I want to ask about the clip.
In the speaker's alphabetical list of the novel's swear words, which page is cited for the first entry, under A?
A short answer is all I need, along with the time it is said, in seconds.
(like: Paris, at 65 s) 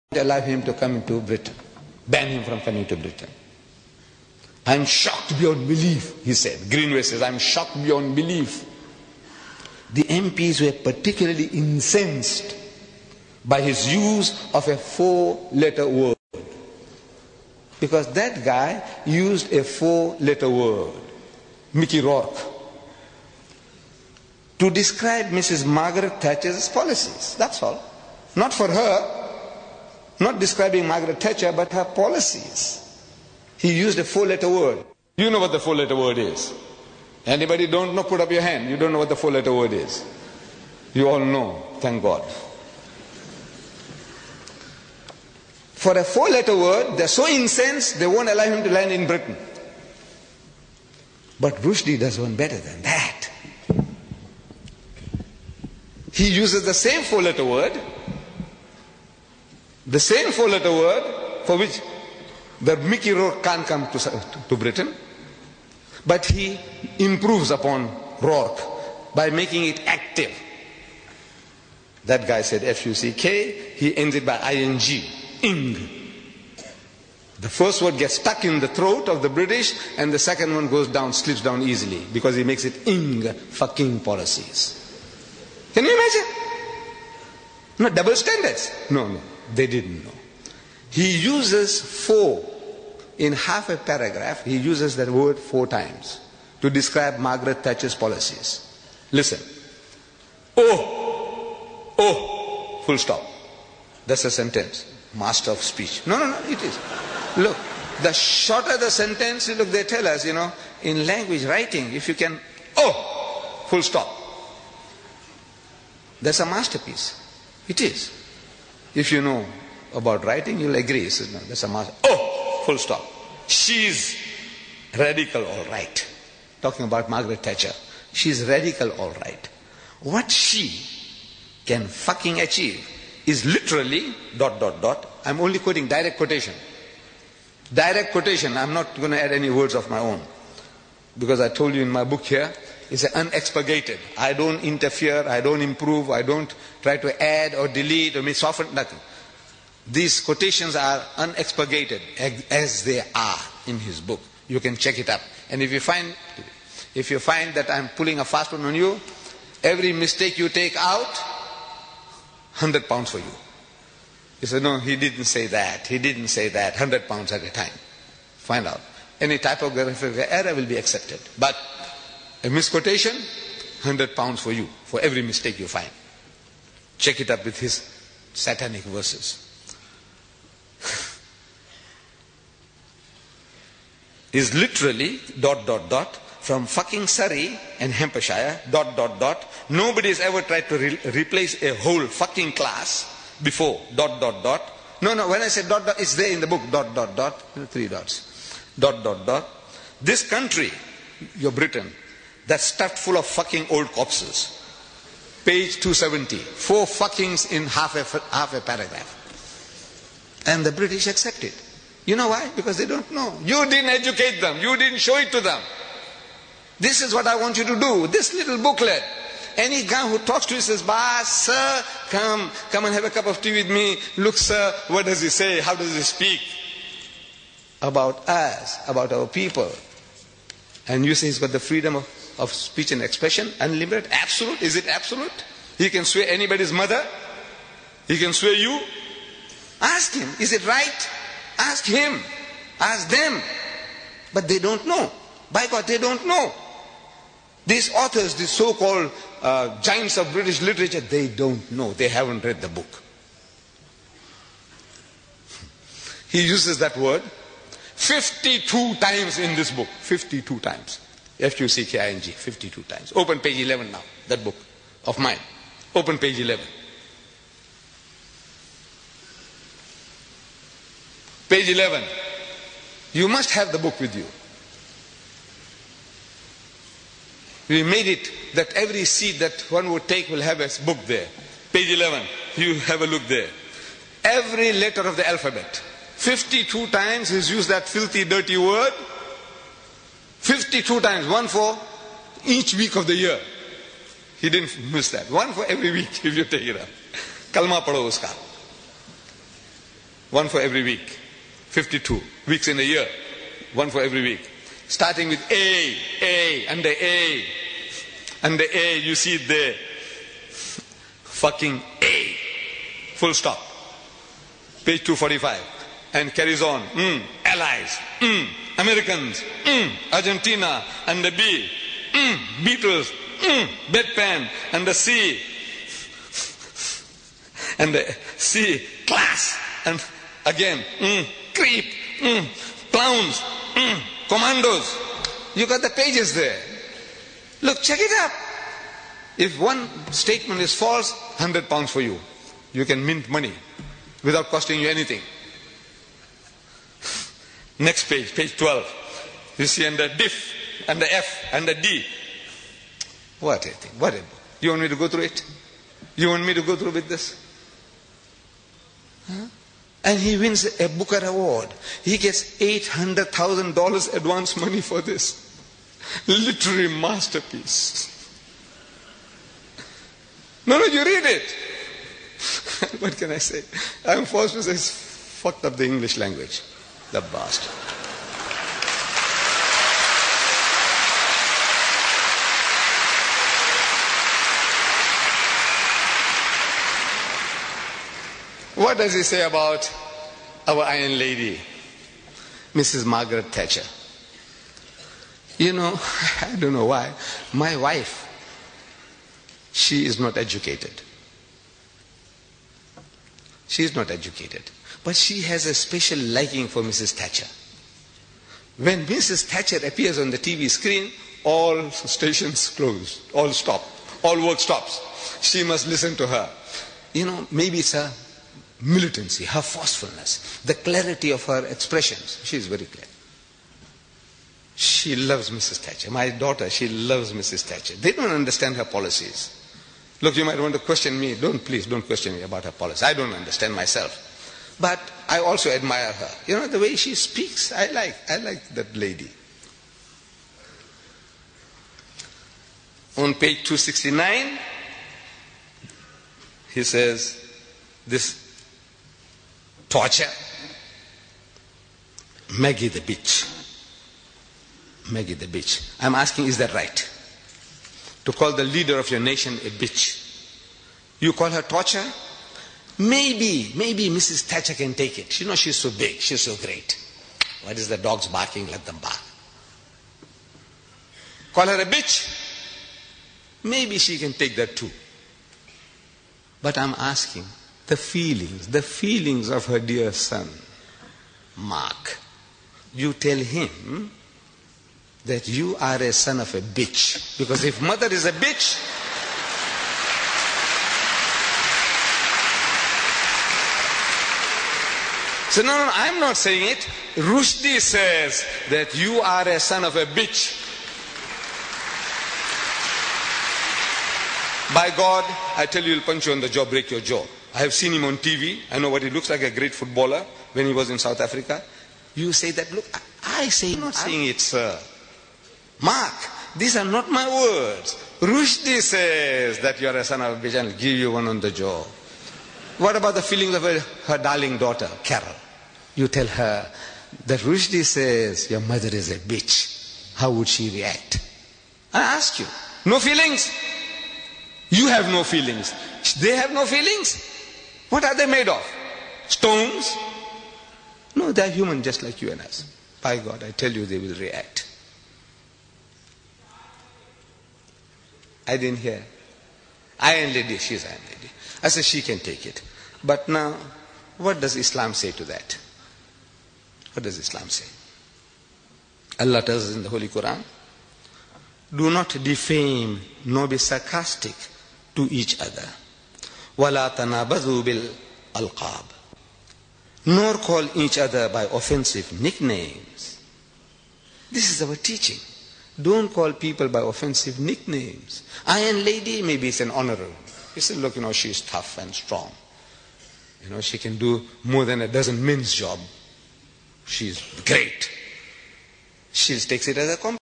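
245, at 314 s.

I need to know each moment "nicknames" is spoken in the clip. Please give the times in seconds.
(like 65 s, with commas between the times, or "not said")
572 s, 577 s.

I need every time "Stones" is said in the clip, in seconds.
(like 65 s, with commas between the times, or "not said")
539 s.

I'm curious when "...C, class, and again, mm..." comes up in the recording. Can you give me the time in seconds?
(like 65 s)
328 s.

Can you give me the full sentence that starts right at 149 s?
These quotations are unexpurgated as they are in his book.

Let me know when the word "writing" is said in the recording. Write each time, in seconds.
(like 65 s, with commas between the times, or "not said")
111 s, 120 s.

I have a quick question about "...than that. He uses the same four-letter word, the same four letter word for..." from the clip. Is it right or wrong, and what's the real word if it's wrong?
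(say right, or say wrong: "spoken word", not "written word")
right.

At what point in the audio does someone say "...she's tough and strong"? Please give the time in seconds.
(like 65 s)
581 s.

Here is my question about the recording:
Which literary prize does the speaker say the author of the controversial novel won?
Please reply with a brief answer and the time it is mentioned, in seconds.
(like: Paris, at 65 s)
Booker Award, at 360 s.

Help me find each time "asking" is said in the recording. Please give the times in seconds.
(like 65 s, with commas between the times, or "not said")
456 s, 476 s.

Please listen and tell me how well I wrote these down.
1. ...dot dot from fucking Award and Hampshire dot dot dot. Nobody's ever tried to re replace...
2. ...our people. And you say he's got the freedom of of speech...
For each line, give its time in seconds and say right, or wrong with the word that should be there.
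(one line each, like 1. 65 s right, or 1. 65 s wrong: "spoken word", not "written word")
1. 185 s wrong: "Surrey", not "Award"
2. 229 s right.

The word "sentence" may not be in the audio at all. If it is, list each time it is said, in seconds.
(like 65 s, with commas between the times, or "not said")
104 s, 108 s.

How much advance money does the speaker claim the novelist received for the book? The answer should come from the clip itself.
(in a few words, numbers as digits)
$800,000.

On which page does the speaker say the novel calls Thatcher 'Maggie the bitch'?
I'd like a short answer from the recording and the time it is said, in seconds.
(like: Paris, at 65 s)
269, at 443 s.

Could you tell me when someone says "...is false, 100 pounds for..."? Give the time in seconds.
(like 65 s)
340 s.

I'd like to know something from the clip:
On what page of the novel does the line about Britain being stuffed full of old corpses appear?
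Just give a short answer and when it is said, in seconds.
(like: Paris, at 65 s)
270, at 205 s.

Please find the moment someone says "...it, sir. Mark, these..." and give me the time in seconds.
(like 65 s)
514 s.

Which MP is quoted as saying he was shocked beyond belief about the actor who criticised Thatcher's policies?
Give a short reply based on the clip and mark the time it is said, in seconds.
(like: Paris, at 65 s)
Greenway, at 6 s.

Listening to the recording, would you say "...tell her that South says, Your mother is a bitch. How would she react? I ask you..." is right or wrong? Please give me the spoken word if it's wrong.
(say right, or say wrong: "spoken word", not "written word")
wrong: "Rushdie", not "South".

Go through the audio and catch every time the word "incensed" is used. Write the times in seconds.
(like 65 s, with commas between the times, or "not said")
11 s, 47 s.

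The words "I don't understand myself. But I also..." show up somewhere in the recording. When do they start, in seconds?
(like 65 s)
433 s.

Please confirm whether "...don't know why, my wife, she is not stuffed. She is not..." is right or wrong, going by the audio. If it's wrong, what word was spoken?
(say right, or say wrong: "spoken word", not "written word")
wrong: "educated", not "stuffed".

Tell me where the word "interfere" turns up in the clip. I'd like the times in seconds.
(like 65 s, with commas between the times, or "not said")
144 s.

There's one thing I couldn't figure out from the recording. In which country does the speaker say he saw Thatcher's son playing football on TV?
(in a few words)
South Africa.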